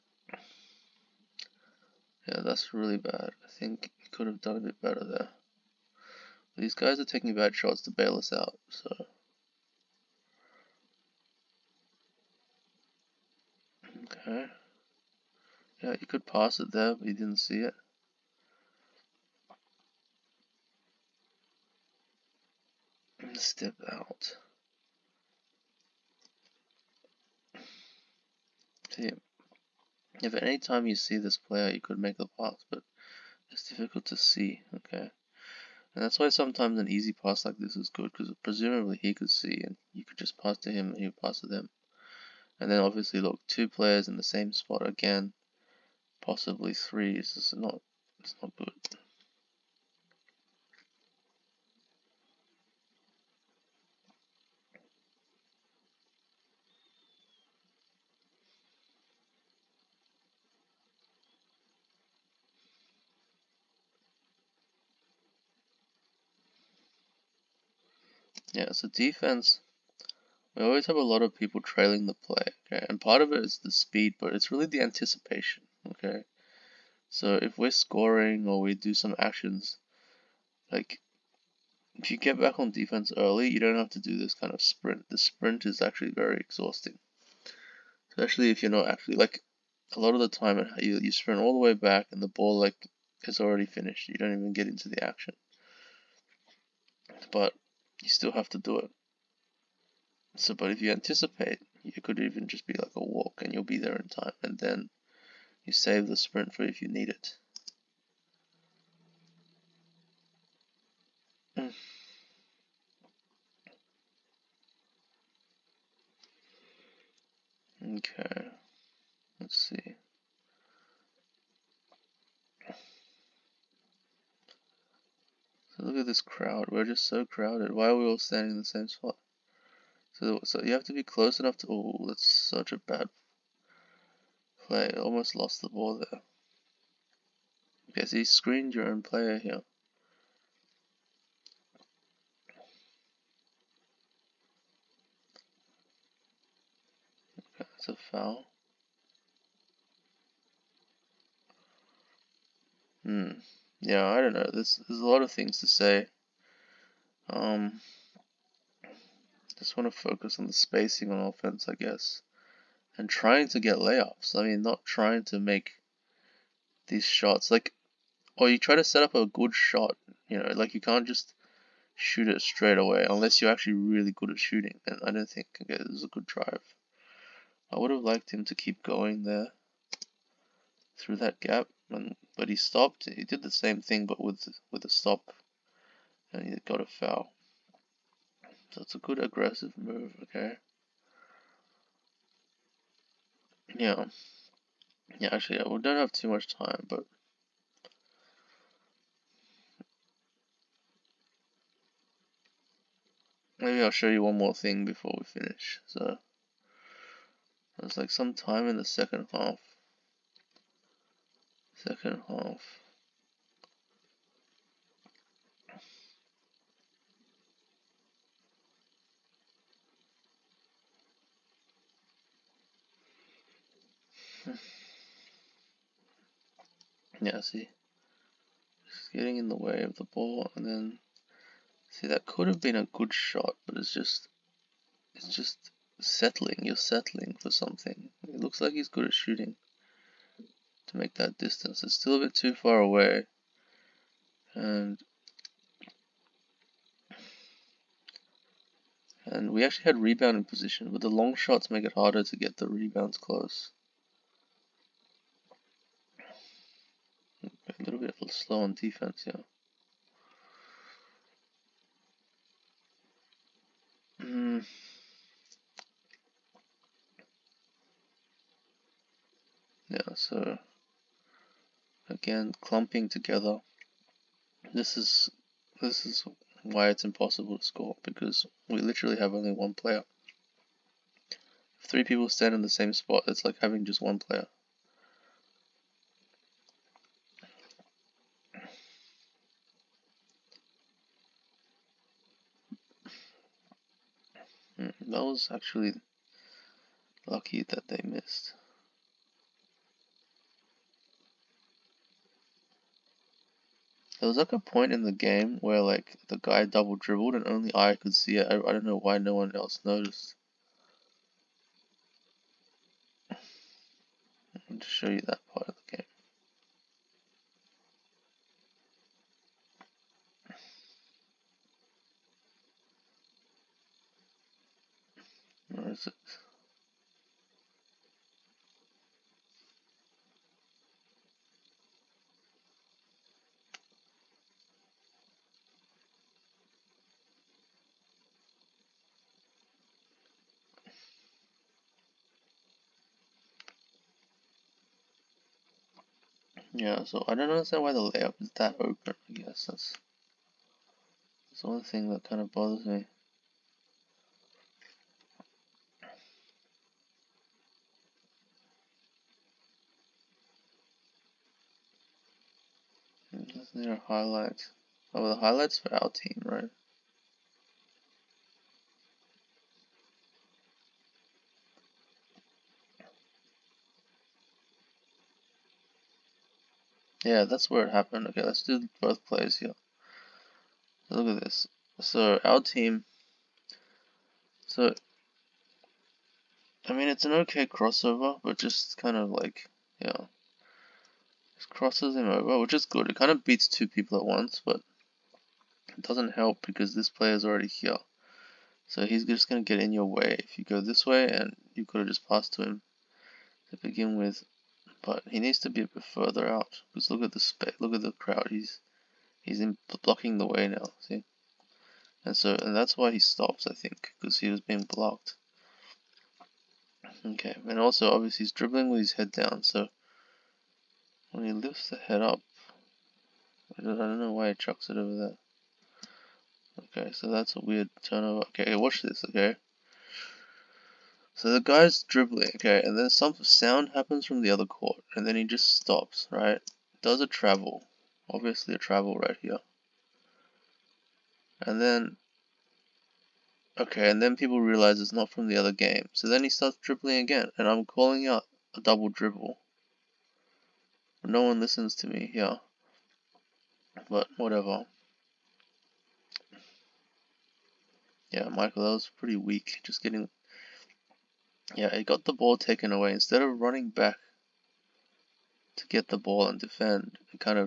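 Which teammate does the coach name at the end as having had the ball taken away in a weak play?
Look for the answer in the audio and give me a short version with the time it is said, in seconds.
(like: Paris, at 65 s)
Michael, at 458 s.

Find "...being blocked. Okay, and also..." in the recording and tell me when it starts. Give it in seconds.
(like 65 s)
414 s.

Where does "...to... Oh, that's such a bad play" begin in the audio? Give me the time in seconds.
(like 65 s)
131 s.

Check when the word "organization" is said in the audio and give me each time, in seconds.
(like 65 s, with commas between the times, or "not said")
not said.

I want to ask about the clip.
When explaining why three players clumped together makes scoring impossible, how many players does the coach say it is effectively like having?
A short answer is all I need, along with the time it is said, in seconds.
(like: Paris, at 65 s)
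1, at 283 s.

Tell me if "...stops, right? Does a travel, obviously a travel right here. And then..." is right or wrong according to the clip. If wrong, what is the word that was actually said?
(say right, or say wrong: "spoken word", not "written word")
right.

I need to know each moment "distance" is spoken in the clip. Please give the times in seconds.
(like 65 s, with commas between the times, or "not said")
241 s.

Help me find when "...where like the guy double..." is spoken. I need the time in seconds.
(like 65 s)
305 s.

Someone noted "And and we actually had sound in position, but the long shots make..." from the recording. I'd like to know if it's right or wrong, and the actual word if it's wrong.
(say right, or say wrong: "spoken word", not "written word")
wrong: "rebound", not "sound".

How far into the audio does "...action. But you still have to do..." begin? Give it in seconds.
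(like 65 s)
95 s.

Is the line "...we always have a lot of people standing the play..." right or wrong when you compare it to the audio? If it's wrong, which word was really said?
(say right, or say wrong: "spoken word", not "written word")
wrong: "trailing", not "standing".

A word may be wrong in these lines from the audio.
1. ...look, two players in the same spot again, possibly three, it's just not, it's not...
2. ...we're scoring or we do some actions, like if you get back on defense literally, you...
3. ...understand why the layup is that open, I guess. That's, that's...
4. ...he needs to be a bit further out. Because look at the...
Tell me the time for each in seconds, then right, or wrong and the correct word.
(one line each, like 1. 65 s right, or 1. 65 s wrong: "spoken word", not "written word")
1. 43 s right
2. 77 s wrong: "early", not "literally"
3. 347 s right
4. 405 s right.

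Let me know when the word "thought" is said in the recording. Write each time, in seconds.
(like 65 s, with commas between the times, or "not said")
not said.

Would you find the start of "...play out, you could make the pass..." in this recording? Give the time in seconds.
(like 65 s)
31 s.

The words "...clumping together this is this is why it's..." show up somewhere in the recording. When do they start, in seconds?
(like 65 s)
272 s.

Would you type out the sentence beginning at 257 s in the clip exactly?
a little bit slow on defense, yeah.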